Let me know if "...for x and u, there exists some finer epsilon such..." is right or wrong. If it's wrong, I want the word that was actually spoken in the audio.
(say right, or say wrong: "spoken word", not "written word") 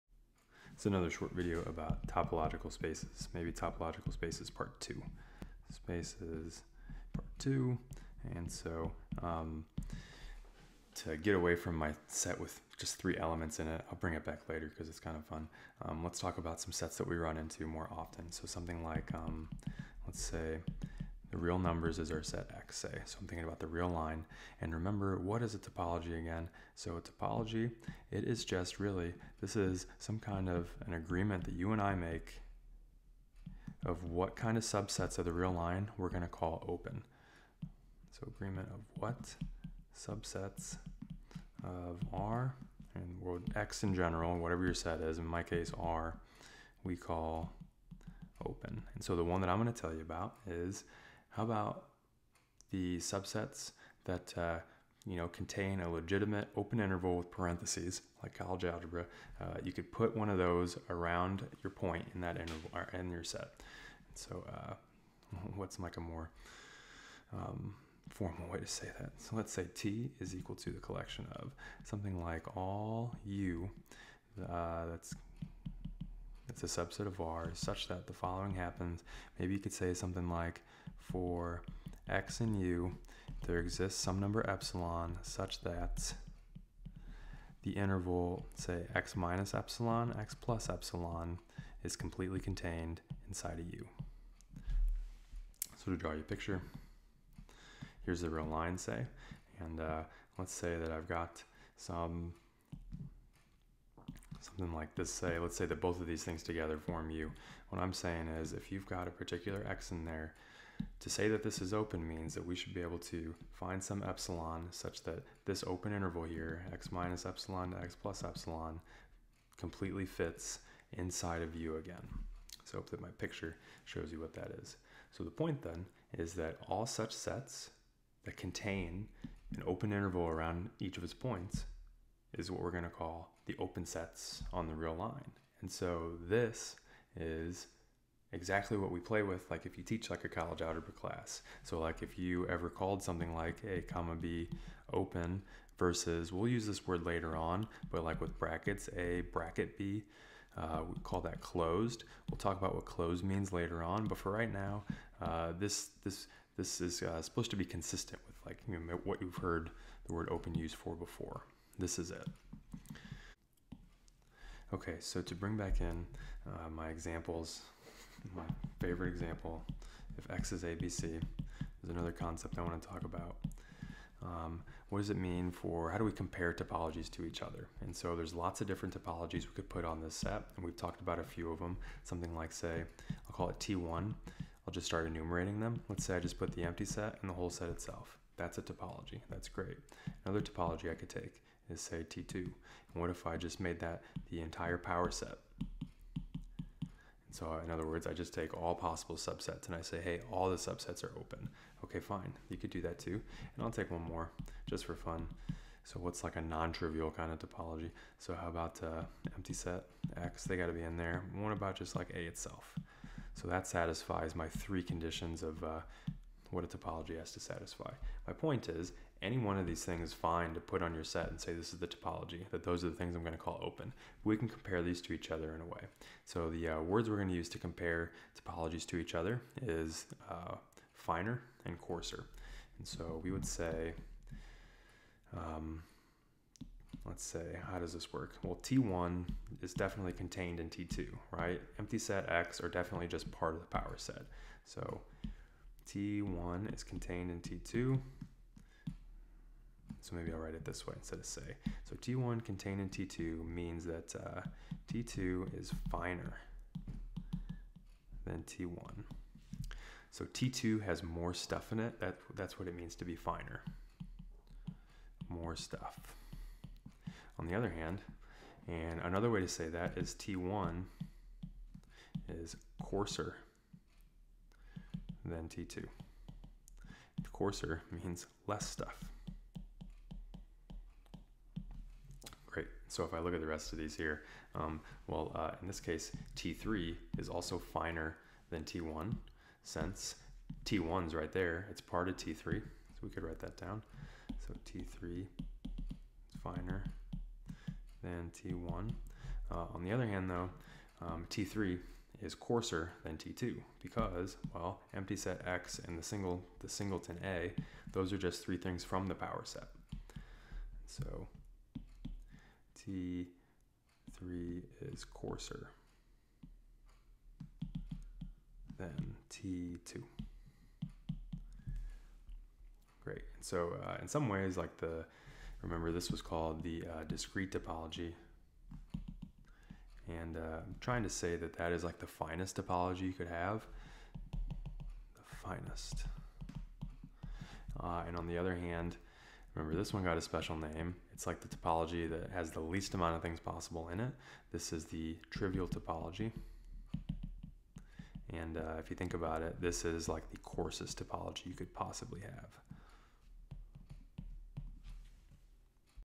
wrong: "number", not "finer".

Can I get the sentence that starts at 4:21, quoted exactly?
That, that's what it means to be finer.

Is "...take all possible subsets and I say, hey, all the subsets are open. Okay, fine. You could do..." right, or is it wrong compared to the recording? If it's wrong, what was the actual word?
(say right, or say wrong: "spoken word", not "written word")
right.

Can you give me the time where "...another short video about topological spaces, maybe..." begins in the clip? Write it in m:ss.
0:00.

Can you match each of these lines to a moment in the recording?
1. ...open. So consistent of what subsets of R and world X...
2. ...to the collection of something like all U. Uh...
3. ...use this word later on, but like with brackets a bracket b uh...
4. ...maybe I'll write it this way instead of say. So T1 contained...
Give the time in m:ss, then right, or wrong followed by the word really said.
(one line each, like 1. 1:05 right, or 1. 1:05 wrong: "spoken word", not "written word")
1. 0:36 wrong: "agreement", not "consistent"
2. 1:10 right
3. 2:26 right
4. 4:10 right.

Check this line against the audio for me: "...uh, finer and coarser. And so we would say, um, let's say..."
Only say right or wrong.
right.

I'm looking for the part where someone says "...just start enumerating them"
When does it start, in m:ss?
3:04.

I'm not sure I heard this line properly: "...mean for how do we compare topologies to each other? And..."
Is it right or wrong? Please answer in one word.
right.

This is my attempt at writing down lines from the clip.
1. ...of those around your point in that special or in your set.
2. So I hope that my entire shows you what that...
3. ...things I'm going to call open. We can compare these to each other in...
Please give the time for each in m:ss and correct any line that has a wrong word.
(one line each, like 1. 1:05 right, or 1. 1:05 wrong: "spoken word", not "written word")
1. 1:00 wrong: "interval", not "special"
2. 2:02 wrong: "picture", not "entire"
3. 3:42 right.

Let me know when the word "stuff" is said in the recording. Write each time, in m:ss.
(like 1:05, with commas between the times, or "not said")
4:21, 4:25, 4:38.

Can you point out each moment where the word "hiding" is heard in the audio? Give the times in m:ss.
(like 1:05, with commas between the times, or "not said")
not said.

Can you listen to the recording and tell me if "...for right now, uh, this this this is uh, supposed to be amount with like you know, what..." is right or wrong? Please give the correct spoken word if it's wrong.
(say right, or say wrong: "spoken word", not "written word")
wrong: "consistent", not "amount".